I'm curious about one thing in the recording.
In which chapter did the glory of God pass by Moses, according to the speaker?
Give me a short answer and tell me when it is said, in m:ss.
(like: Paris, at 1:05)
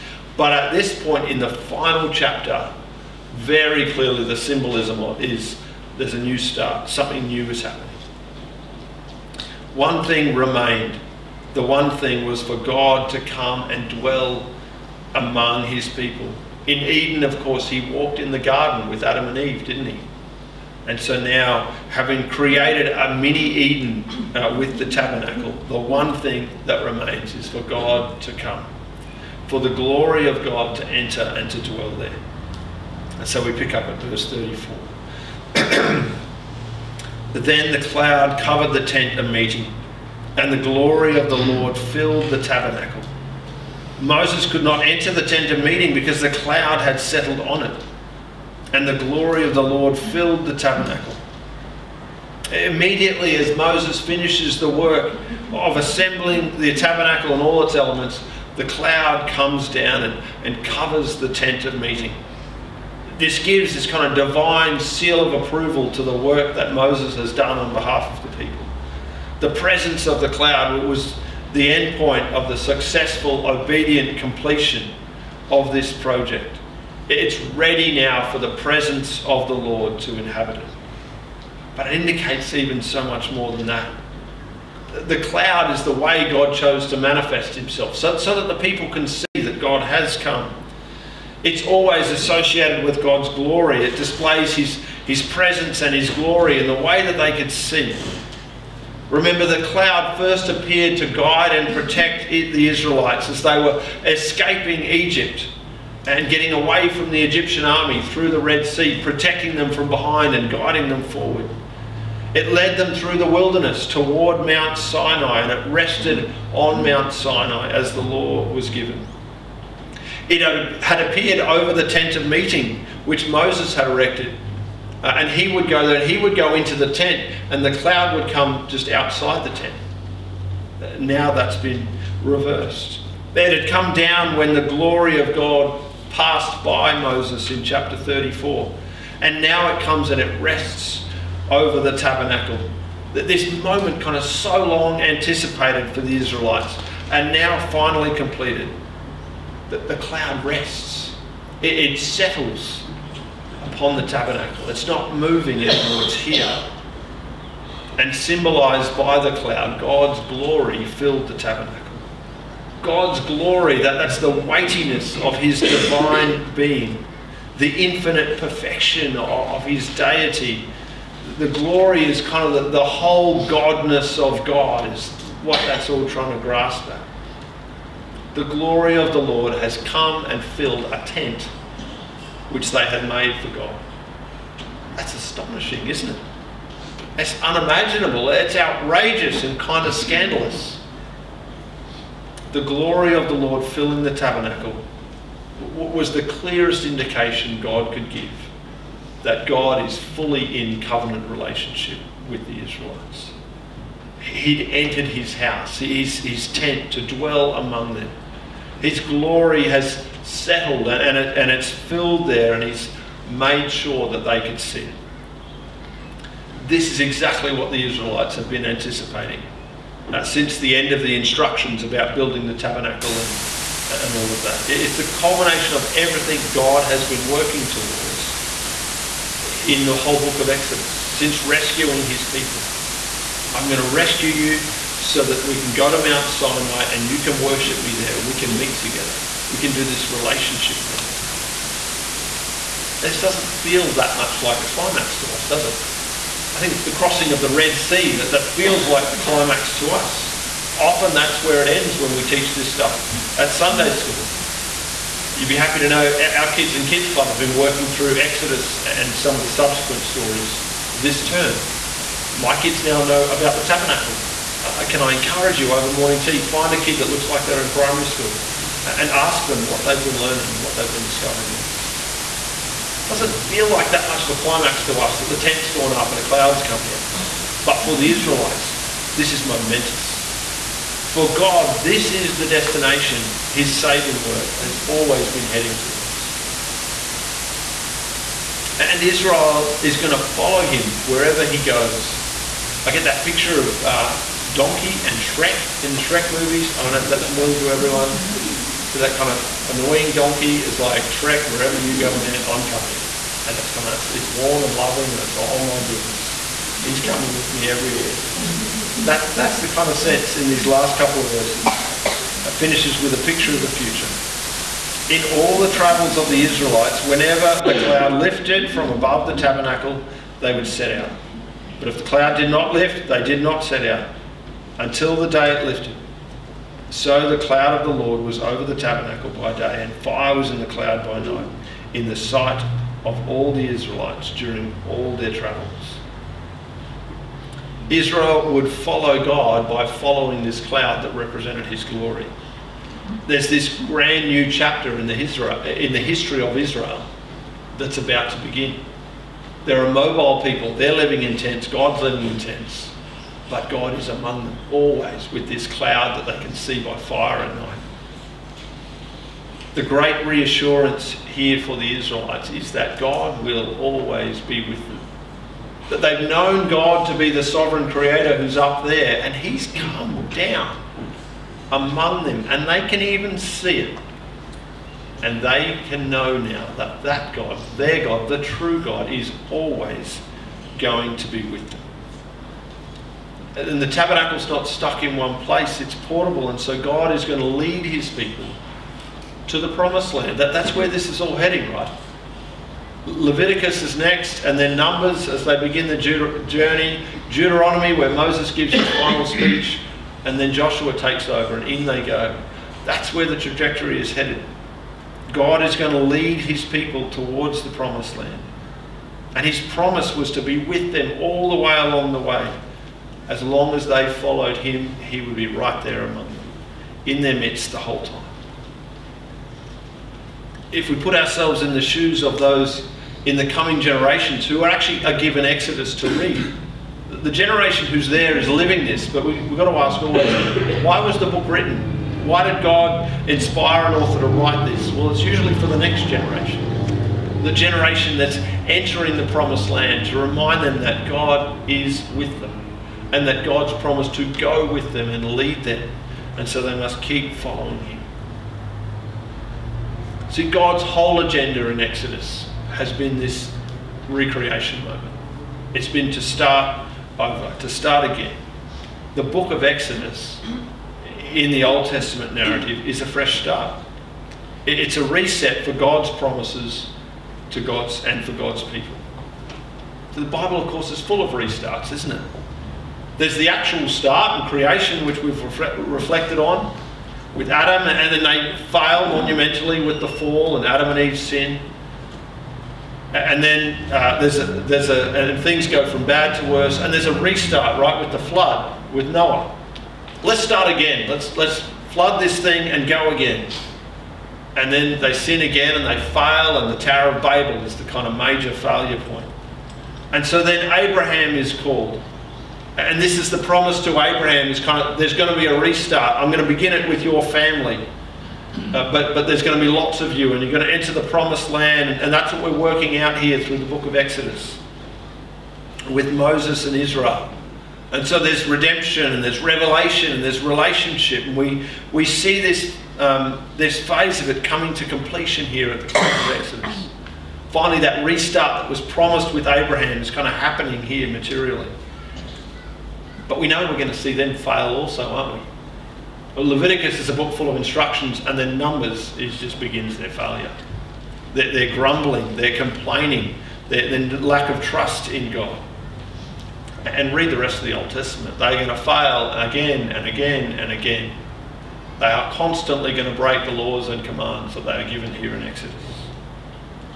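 34, at 2:17.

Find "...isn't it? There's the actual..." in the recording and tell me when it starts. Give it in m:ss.
7:51.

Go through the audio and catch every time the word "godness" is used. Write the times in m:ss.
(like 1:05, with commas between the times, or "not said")
2:53.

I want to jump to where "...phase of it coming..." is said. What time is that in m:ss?
8:43.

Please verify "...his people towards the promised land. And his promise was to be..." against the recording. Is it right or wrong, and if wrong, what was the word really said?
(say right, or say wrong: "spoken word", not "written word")
right.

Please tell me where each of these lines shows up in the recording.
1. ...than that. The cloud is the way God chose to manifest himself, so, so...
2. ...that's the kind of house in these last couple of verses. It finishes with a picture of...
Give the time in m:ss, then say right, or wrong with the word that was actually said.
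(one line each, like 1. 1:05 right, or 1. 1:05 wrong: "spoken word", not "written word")
1. 1:23 right
2. 5:09 wrong: "sense", not "house".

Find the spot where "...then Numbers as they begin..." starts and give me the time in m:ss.
6:34.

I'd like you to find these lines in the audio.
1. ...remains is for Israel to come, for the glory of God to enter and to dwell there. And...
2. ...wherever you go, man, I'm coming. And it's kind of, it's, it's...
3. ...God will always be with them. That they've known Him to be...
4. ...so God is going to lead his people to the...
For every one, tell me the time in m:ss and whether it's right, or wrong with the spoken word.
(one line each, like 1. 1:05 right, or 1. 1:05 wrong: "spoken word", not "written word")
1. 0:26 wrong: "God", not "Israel"
2. 5:01 right
3. 6:02 wrong: "God", not "Him"
4. 6:26 right.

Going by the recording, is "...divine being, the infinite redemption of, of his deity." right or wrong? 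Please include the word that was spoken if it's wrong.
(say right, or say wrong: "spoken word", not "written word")
wrong: "perfection", not "redemption".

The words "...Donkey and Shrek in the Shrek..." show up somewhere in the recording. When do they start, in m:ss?
4:54.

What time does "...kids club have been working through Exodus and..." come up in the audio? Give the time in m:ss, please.
4:16.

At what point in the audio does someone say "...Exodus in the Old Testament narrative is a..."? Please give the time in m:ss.
7:39.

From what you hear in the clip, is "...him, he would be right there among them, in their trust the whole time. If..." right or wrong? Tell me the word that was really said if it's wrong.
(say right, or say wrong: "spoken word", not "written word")
wrong: "midst", not "trust".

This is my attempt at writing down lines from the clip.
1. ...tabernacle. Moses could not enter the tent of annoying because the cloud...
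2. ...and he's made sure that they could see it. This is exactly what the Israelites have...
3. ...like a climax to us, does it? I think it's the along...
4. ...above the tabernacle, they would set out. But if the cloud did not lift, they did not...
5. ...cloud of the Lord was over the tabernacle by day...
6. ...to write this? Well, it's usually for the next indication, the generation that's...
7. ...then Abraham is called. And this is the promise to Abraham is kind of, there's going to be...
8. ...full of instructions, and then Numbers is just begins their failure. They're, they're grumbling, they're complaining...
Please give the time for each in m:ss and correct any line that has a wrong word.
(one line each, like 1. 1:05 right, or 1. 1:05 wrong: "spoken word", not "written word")
1. 0:42 wrong: "meeting", not "annoying"
2. 3:32 right
3. 4:04 wrong: "crossing", not "along"
4. 5:18 right
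5. 5:27 right
6. 7:14 wrong: "generation", not "indication"
7. 8:20 right
8. 8:57 right.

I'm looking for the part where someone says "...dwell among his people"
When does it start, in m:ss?
0:13.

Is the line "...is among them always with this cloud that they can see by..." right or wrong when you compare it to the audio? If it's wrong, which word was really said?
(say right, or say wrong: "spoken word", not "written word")
right.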